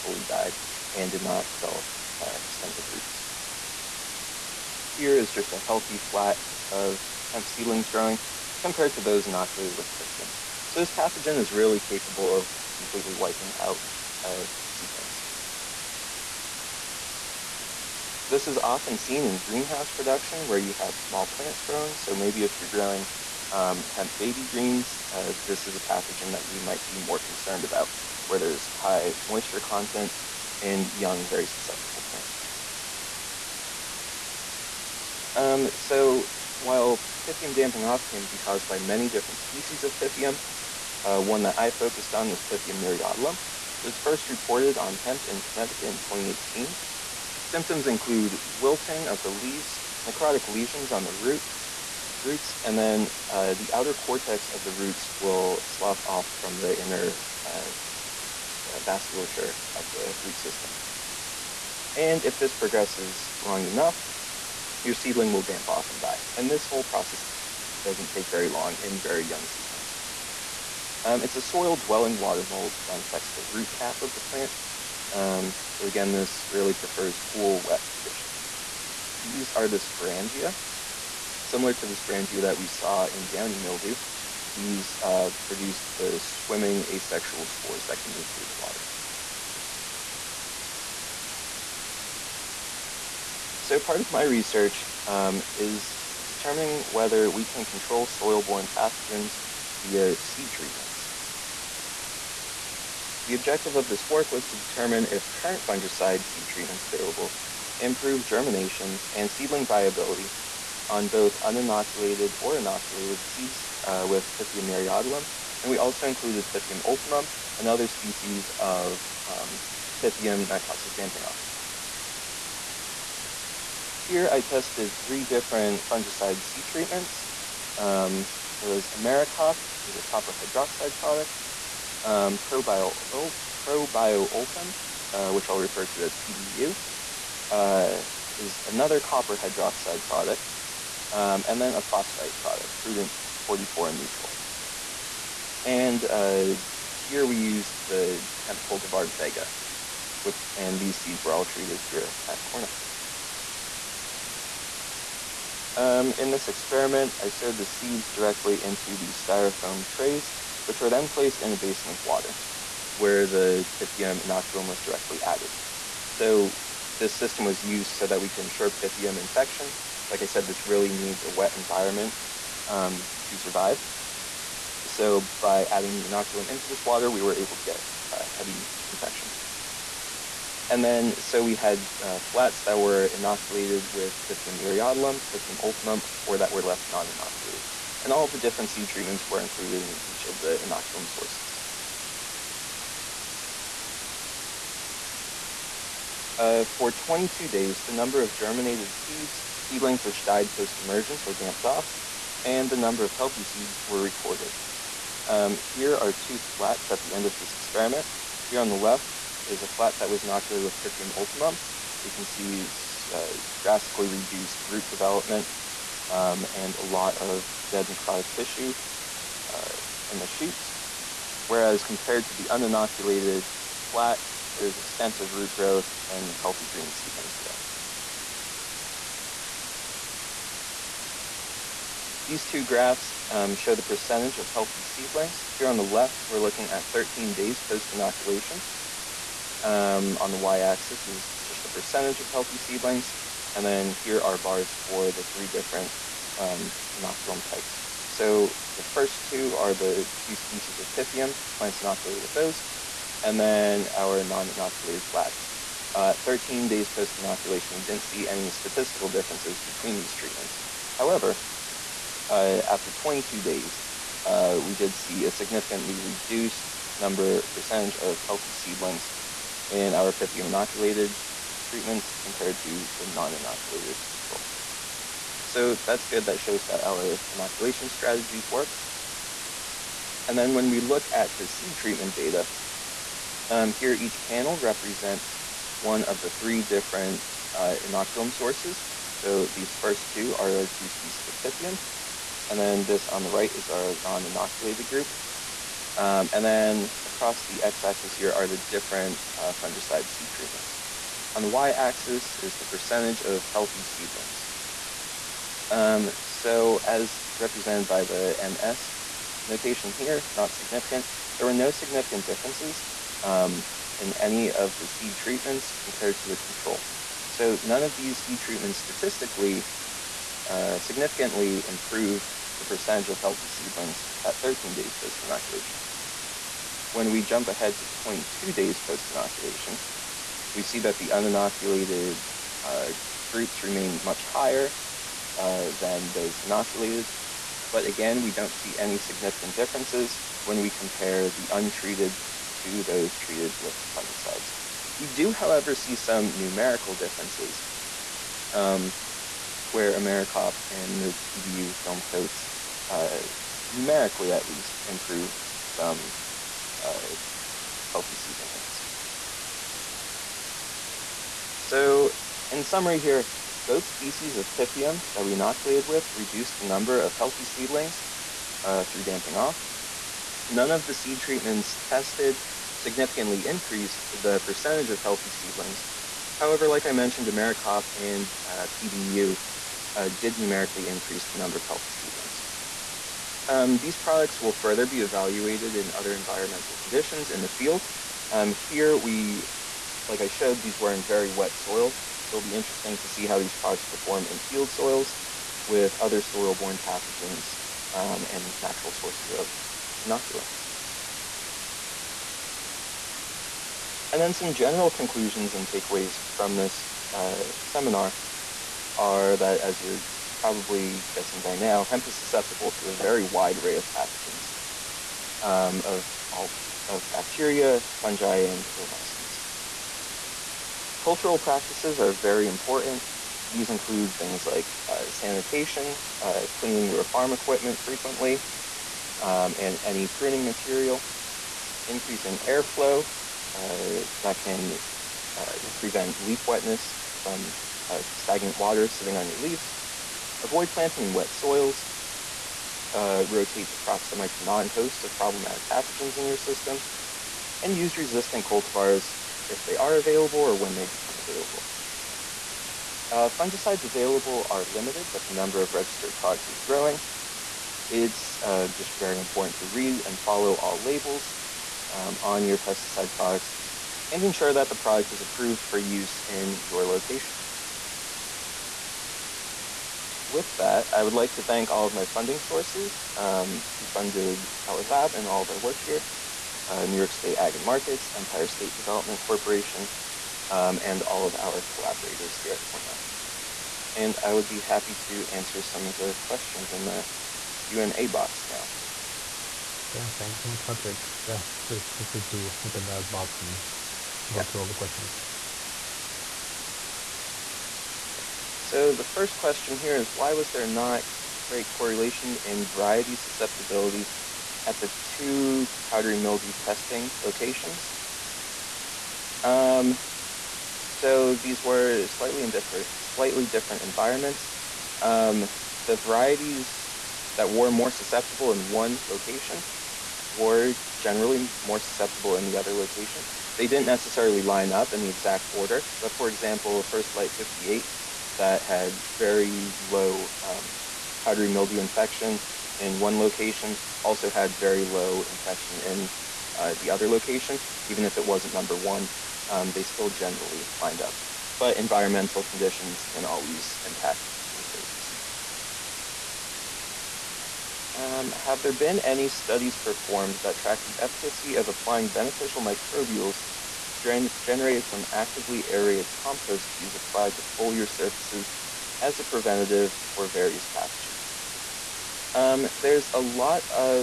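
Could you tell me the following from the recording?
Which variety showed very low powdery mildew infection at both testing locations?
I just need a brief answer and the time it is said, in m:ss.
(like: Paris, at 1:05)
First Light 58, at 8:46.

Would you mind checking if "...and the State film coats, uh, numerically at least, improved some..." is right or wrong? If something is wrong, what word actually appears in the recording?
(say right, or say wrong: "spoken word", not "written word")
wrong: "PBU", not "State".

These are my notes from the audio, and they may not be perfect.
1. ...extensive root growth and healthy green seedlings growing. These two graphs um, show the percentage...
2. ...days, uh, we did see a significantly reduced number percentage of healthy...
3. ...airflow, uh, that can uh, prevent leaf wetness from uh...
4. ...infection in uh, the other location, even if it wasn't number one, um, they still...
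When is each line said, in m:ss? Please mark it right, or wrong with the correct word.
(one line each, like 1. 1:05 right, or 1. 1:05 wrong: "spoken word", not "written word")
1. 3:44 right
2. 4:23 right
3. 7:12 right
4. 8:55 right.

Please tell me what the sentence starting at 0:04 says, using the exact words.
Here is just a healthy flat of hemp seedlings growing compared to those inoculated with Pythium.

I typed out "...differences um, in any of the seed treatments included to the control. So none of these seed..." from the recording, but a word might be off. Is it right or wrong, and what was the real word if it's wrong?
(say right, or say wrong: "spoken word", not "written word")
wrong: "compared", not "included".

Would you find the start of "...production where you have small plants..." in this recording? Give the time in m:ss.
0:19.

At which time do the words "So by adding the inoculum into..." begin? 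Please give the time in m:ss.
2:54.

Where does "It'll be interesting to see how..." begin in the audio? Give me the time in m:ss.
6:32.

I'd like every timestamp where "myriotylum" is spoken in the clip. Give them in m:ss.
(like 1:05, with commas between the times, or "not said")
0:42, 1:54, 3:04.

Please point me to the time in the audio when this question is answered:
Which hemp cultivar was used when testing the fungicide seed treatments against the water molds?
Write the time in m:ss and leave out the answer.
2:29.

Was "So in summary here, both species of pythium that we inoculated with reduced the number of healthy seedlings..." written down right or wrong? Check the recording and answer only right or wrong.
right.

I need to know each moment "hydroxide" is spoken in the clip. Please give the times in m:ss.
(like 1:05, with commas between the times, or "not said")
2:10, 2:19.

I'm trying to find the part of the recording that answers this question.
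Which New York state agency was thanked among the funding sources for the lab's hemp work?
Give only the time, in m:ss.
7:56.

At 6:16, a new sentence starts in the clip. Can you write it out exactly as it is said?
However, like I mentioned, AmeriCOP and uh, PBU uh, did numerically increase the number of healthy seedlings.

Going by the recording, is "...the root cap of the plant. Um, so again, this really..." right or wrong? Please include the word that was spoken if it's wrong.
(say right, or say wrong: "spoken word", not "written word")
right.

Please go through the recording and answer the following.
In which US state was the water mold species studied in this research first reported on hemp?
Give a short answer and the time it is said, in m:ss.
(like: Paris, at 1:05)
Connecticut, at 0:45.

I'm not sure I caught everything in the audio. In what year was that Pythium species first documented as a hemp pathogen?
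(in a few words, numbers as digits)
2018.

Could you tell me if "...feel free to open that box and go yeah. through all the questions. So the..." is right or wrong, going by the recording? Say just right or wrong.
right.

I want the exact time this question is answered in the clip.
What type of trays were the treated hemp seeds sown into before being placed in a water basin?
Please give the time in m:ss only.
2:39.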